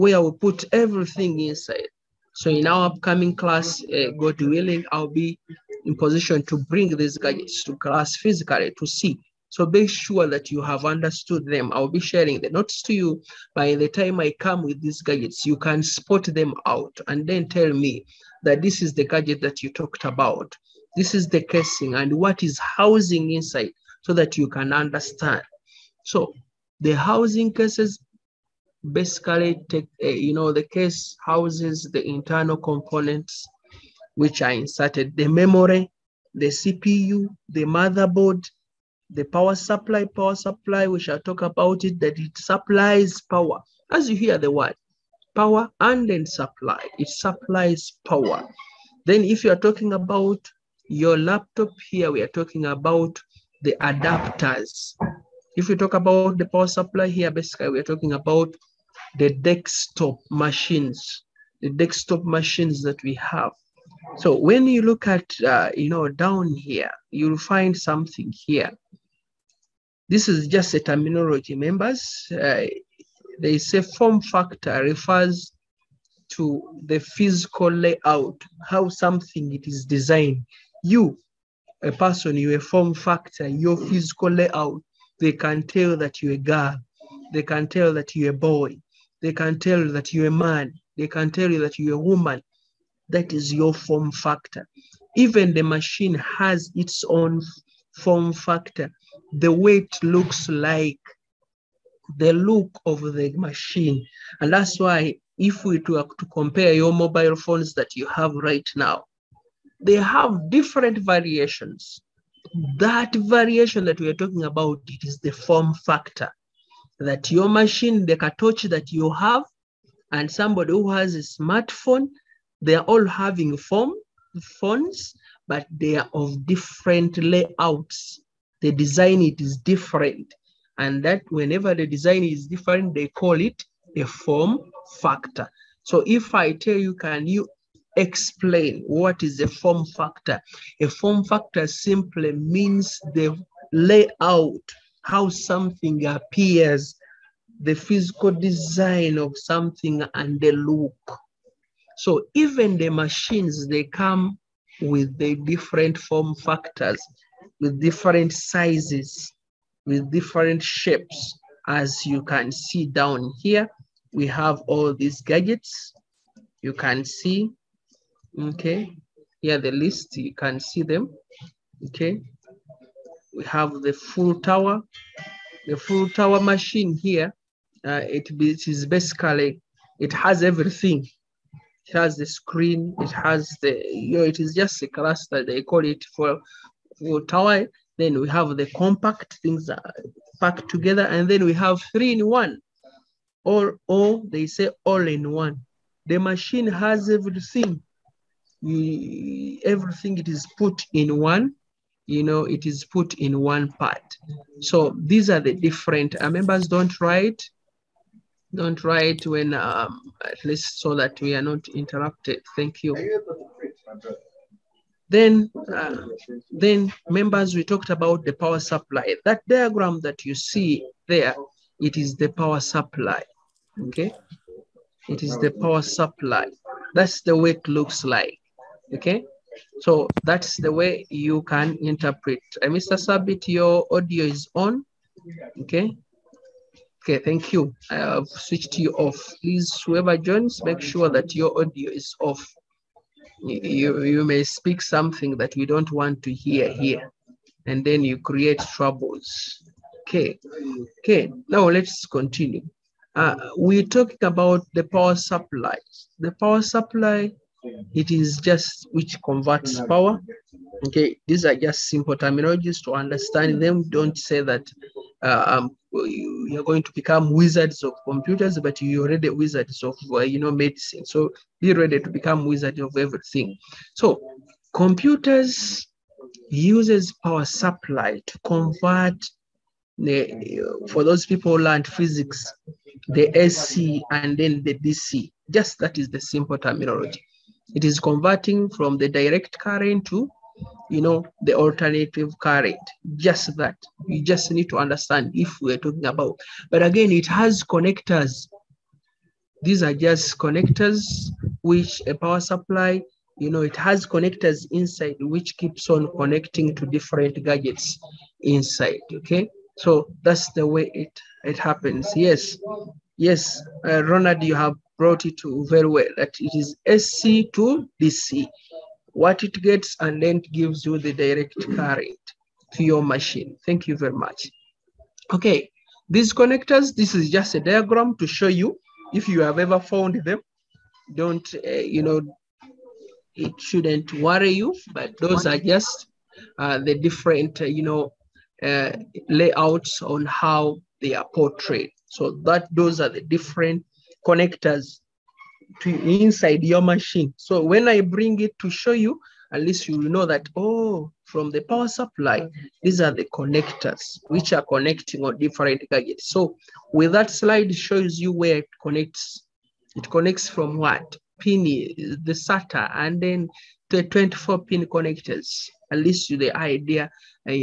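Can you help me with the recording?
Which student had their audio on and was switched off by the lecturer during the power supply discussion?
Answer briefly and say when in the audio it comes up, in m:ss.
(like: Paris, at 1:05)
Mr. Sabit, at 3:52.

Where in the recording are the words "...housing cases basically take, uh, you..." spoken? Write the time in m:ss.
0:26.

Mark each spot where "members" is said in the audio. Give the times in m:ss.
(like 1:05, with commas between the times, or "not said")
1:11, 3:26, 3:37.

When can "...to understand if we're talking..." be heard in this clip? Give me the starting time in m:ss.
4:54.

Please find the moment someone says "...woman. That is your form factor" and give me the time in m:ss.
1:32.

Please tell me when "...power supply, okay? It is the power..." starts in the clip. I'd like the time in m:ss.
3:42.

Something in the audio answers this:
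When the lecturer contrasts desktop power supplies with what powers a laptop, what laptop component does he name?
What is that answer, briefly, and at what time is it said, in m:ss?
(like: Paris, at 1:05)
adapters, at 0:53.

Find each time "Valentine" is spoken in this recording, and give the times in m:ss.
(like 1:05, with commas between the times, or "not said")
not said.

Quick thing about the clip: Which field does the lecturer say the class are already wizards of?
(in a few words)
medicine.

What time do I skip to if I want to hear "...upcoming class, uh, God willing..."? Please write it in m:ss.
0:02.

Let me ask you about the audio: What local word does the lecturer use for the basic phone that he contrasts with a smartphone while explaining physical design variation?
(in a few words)
katochi.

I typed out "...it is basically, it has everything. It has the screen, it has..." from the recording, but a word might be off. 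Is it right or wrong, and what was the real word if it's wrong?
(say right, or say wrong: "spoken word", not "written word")
right.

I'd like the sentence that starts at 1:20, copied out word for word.
You, a person, you a form factor, your physical layout, they can tell that you're a girl.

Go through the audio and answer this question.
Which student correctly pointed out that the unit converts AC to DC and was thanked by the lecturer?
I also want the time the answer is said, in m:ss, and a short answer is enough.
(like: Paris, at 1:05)
Ronald, at 5:14.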